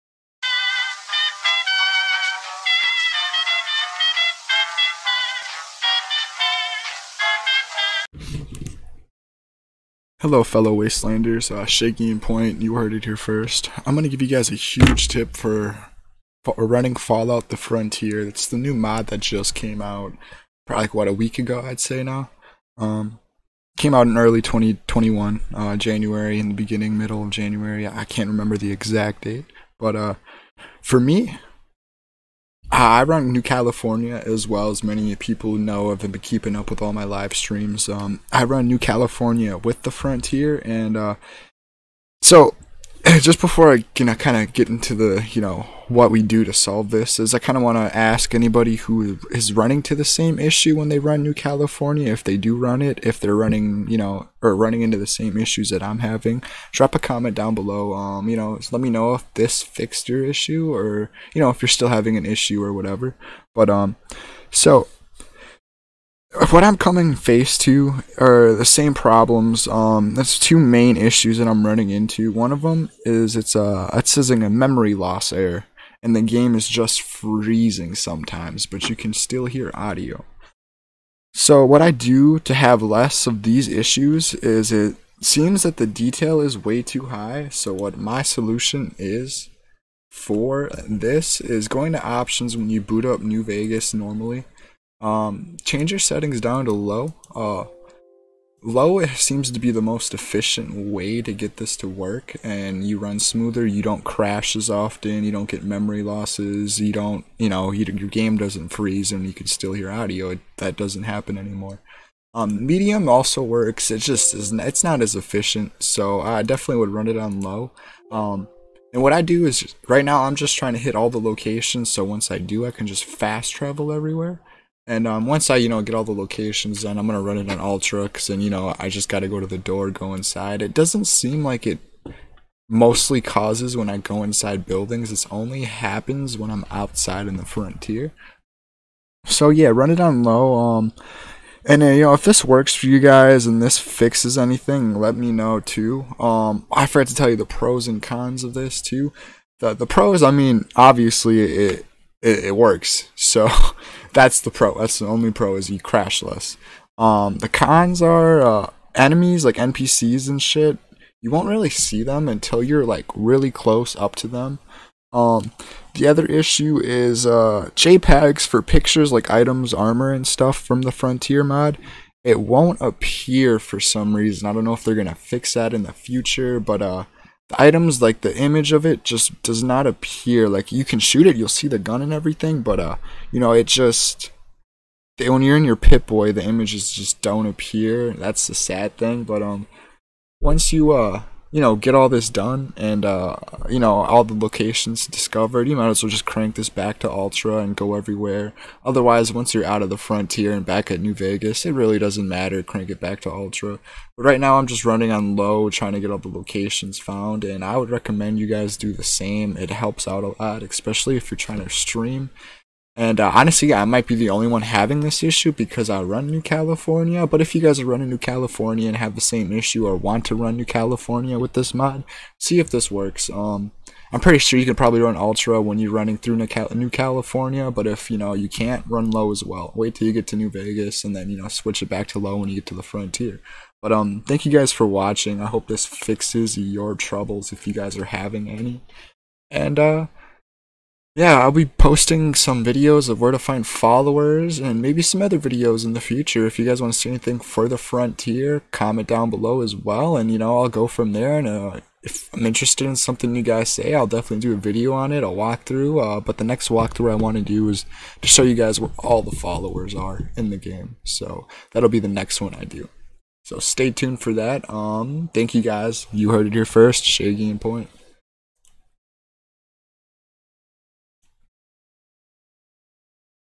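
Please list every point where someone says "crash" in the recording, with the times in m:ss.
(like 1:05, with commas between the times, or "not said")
1:44, 2:35.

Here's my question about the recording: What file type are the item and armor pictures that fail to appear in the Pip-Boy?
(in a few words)
JPEGs.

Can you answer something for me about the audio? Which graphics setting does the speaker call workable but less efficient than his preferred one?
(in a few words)
Medium.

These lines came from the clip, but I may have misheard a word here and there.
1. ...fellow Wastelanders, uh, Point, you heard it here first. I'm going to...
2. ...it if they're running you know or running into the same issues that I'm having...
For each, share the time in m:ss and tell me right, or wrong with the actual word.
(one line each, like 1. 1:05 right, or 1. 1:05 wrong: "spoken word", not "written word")
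1. 0:10 right
2. 0:52 right.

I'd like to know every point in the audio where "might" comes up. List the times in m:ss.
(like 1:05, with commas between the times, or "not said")
3:15, 3:33.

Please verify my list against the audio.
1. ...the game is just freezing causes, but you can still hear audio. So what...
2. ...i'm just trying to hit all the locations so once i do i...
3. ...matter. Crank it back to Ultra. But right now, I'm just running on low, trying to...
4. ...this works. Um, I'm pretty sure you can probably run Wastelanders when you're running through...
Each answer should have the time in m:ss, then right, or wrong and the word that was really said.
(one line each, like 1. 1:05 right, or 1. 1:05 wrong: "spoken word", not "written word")
1. 1:16 wrong: "sometimes", not "causes"
2. 2:00 right
3. 3:22 right
4. 3:42 wrong: "Ultra", not "Wastelanders".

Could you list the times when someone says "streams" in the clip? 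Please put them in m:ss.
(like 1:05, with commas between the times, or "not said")
0:37, 3:31.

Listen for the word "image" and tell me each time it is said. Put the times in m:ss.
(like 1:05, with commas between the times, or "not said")
2:58, 3:06.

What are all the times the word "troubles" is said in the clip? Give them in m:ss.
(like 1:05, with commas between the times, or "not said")
3:56.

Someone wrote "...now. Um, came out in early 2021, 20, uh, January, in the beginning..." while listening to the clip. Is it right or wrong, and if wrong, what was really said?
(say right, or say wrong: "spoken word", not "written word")
right.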